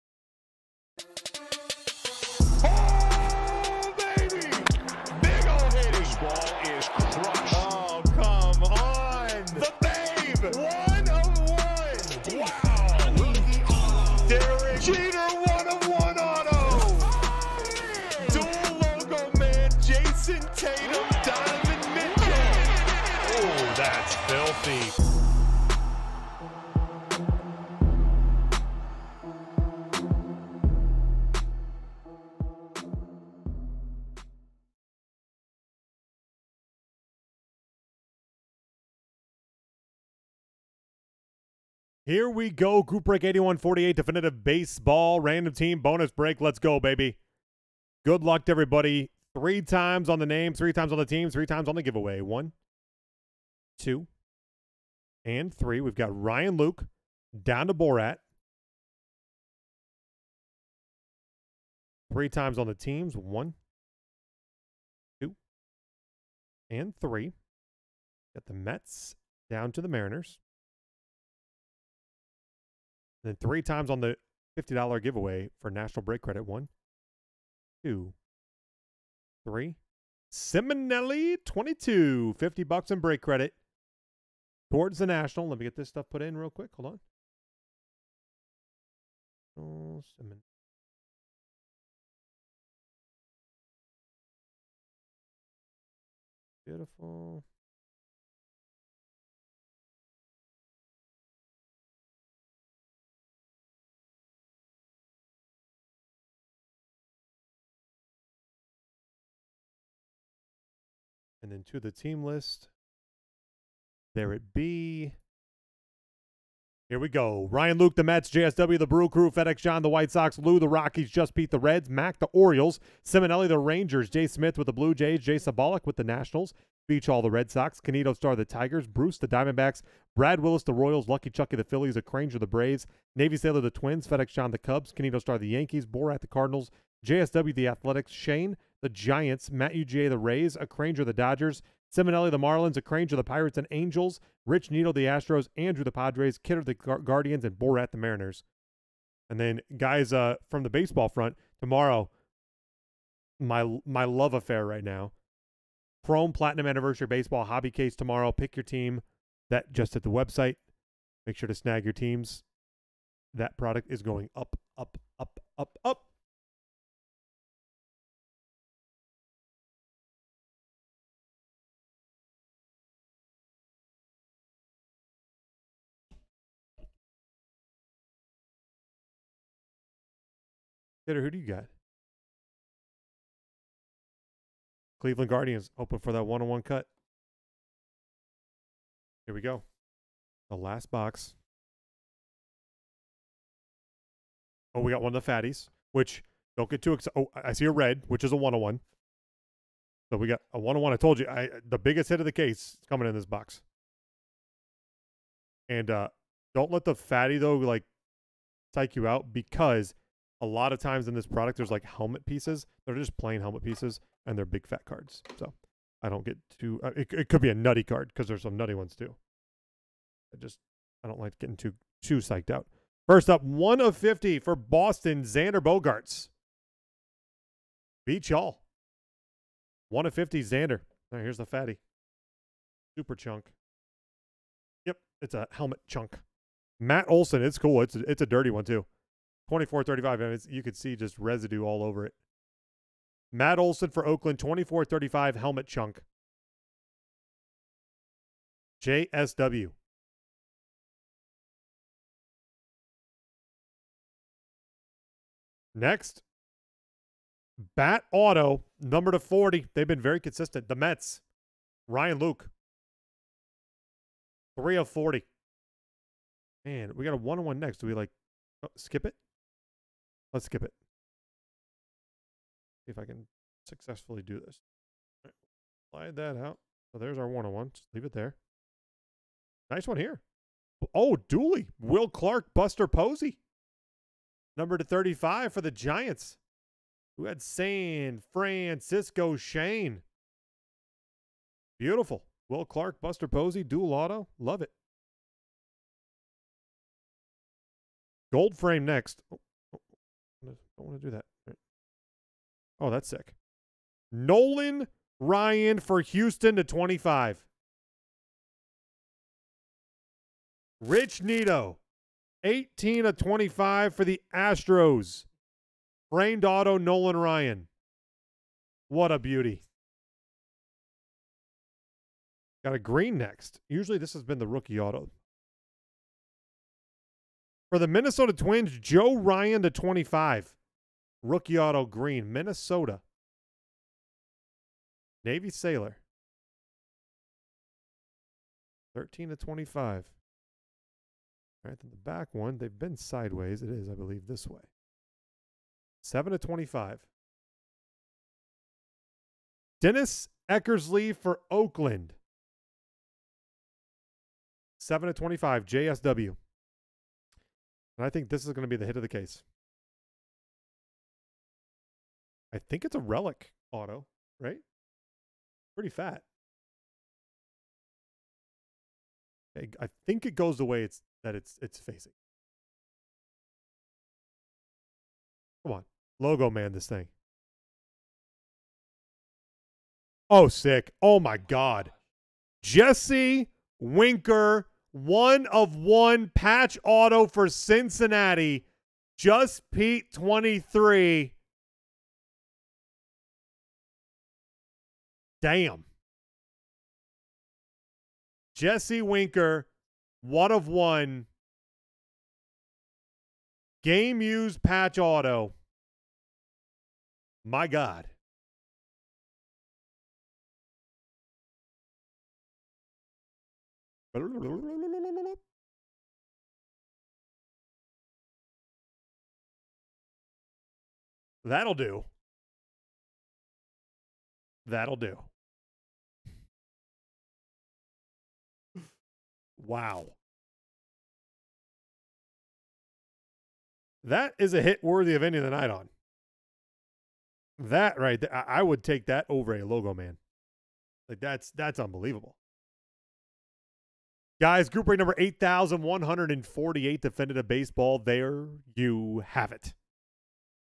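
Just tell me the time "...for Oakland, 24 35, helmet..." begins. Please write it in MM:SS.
04:03.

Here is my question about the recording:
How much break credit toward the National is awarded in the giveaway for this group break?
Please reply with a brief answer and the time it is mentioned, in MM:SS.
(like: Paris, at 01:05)
$50, at 01:22.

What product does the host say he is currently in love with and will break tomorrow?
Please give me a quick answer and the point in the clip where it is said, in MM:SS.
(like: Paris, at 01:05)
Chrome Platinum Anniversary Baseball, at 02:36.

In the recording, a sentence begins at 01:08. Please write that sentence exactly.
Got the Mets down to the Mariners then three times on the $50 giveaway for National Break Credit.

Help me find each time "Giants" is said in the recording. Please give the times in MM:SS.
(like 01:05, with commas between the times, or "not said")
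02:18, 04:45.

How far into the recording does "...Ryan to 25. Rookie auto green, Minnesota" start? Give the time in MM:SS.
05:29.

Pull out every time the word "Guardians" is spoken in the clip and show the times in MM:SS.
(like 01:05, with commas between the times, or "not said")
02:26, 03:05.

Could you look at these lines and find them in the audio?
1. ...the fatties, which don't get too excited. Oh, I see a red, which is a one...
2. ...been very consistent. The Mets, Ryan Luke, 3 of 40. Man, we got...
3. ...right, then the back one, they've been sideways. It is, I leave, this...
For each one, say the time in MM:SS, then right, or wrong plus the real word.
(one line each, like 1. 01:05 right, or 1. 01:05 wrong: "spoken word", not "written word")
1. 03:15 right
2. 04:19 right
3. 05:41 wrong: "believe", not "leave".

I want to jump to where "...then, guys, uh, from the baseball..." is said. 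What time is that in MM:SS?
02:29.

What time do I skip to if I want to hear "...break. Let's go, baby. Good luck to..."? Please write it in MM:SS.
00:46.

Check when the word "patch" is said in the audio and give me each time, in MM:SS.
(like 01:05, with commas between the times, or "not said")
06:26, 06:44.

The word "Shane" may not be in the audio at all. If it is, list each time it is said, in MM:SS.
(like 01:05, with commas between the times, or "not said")
02:18, 04:49.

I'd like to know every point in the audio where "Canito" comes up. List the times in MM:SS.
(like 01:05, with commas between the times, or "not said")
02:07, 02:14.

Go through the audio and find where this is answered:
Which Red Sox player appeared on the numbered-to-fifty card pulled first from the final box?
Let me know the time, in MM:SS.
03:45.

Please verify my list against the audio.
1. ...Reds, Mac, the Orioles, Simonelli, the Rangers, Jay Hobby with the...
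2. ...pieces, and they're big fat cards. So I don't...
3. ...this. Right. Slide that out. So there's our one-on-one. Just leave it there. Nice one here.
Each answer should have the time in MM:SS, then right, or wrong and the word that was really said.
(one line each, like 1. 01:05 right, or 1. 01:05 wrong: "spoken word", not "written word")
1. 02:01 wrong: "Smith", not "Hobby"
2. 03:33 right
3. 04:34 right.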